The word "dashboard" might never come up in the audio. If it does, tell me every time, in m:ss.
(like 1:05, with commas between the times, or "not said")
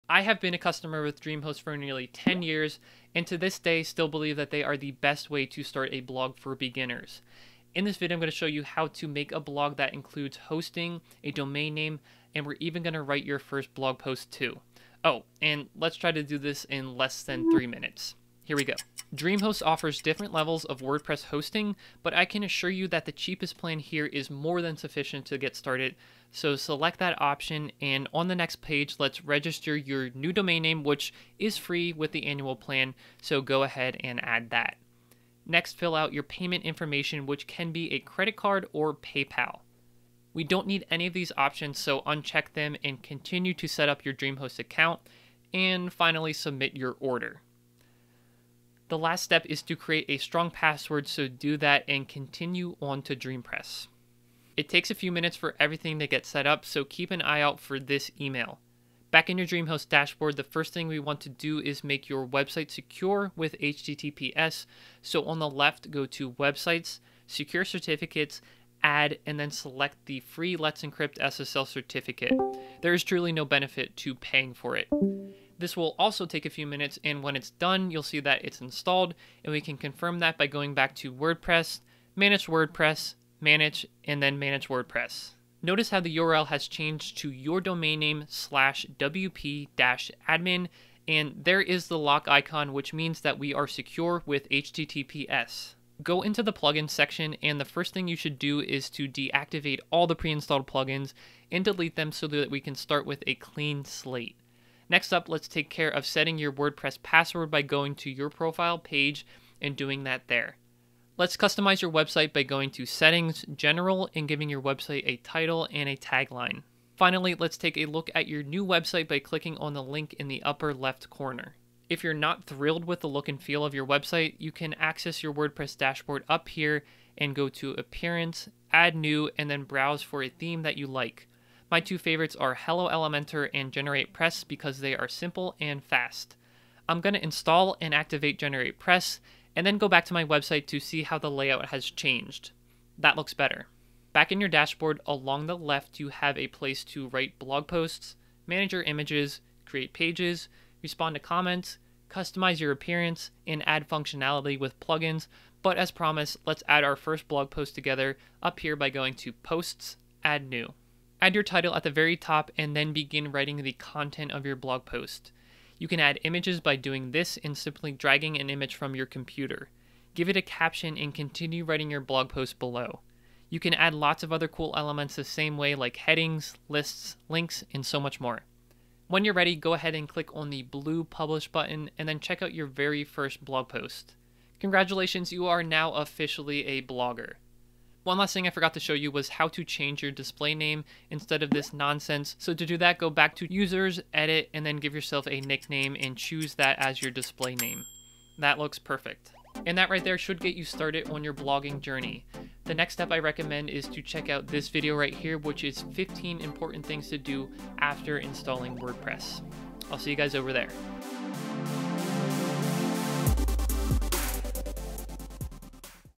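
0:59, 2:05, 2:24.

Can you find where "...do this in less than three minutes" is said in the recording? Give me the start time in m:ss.
0:16.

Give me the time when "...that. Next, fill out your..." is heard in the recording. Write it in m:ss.
0:34.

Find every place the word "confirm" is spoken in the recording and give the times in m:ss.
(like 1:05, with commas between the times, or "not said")
1:19.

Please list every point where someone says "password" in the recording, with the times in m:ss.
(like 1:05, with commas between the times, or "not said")
0:50, 1:47.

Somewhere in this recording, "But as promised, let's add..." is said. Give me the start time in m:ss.
2:35.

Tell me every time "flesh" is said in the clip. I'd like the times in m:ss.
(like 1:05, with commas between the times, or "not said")
not said.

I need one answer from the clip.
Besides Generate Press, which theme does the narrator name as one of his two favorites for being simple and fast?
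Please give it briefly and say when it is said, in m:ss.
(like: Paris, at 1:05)
Hello Elementor, at 2:12.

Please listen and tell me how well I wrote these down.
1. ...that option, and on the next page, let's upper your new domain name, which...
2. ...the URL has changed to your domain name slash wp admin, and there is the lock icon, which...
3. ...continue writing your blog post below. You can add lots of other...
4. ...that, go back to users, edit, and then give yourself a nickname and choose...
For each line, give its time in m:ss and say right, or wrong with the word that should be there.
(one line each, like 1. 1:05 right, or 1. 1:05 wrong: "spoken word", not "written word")
1. 0:26 wrong: "register", not "upper"
2. 1:25 right
3. 2:51 right
4. 3:12 right.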